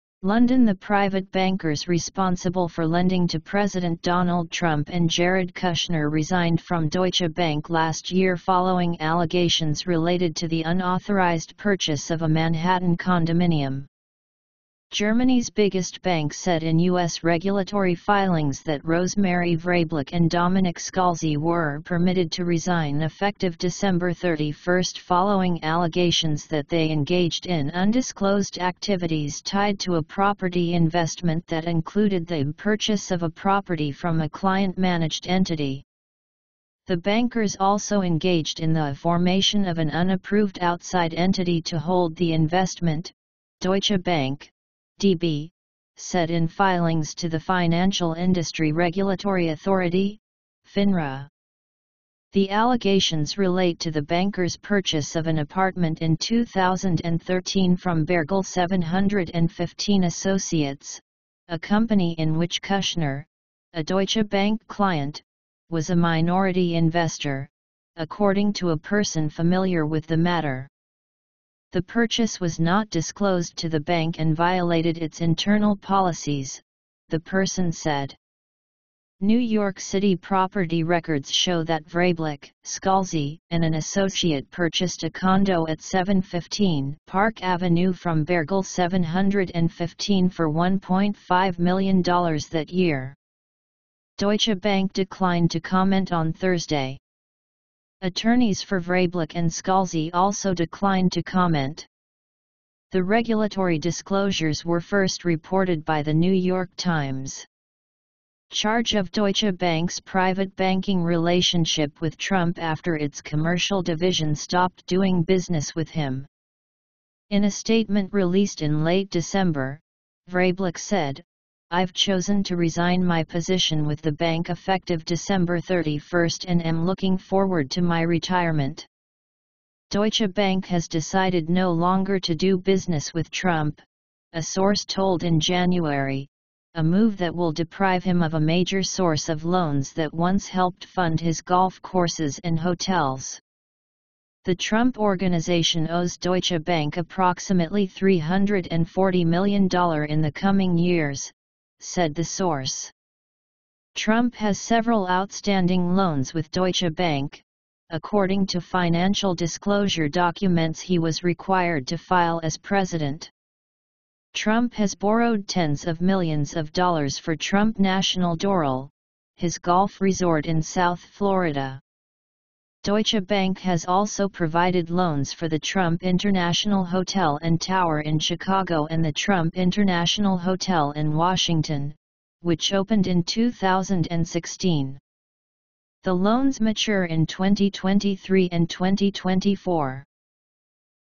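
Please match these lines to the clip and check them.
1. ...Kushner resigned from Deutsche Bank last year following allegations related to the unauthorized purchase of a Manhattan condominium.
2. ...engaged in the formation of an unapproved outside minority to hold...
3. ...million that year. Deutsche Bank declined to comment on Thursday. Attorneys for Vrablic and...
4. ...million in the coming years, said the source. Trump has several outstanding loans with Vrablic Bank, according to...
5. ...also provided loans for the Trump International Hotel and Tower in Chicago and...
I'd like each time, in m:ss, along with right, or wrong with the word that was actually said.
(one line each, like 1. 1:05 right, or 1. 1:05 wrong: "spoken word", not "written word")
1. 0:05 right
2. 0:38 wrong: "entity", not "minority"
3. 1:31 right
4. 2:29 wrong: "Deutsche", not "Vrablic"
5. 2:53 right.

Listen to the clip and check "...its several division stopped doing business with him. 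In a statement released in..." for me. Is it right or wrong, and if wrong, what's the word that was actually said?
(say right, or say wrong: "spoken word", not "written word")
wrong: "commercial", not "several".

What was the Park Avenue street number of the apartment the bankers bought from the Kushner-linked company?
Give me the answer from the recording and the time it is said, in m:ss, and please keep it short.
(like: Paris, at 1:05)
715, at 1:25.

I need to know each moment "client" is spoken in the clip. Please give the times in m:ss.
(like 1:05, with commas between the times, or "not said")
0:34, 1:04.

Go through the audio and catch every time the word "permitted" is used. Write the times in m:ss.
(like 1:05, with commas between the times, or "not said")
0:21.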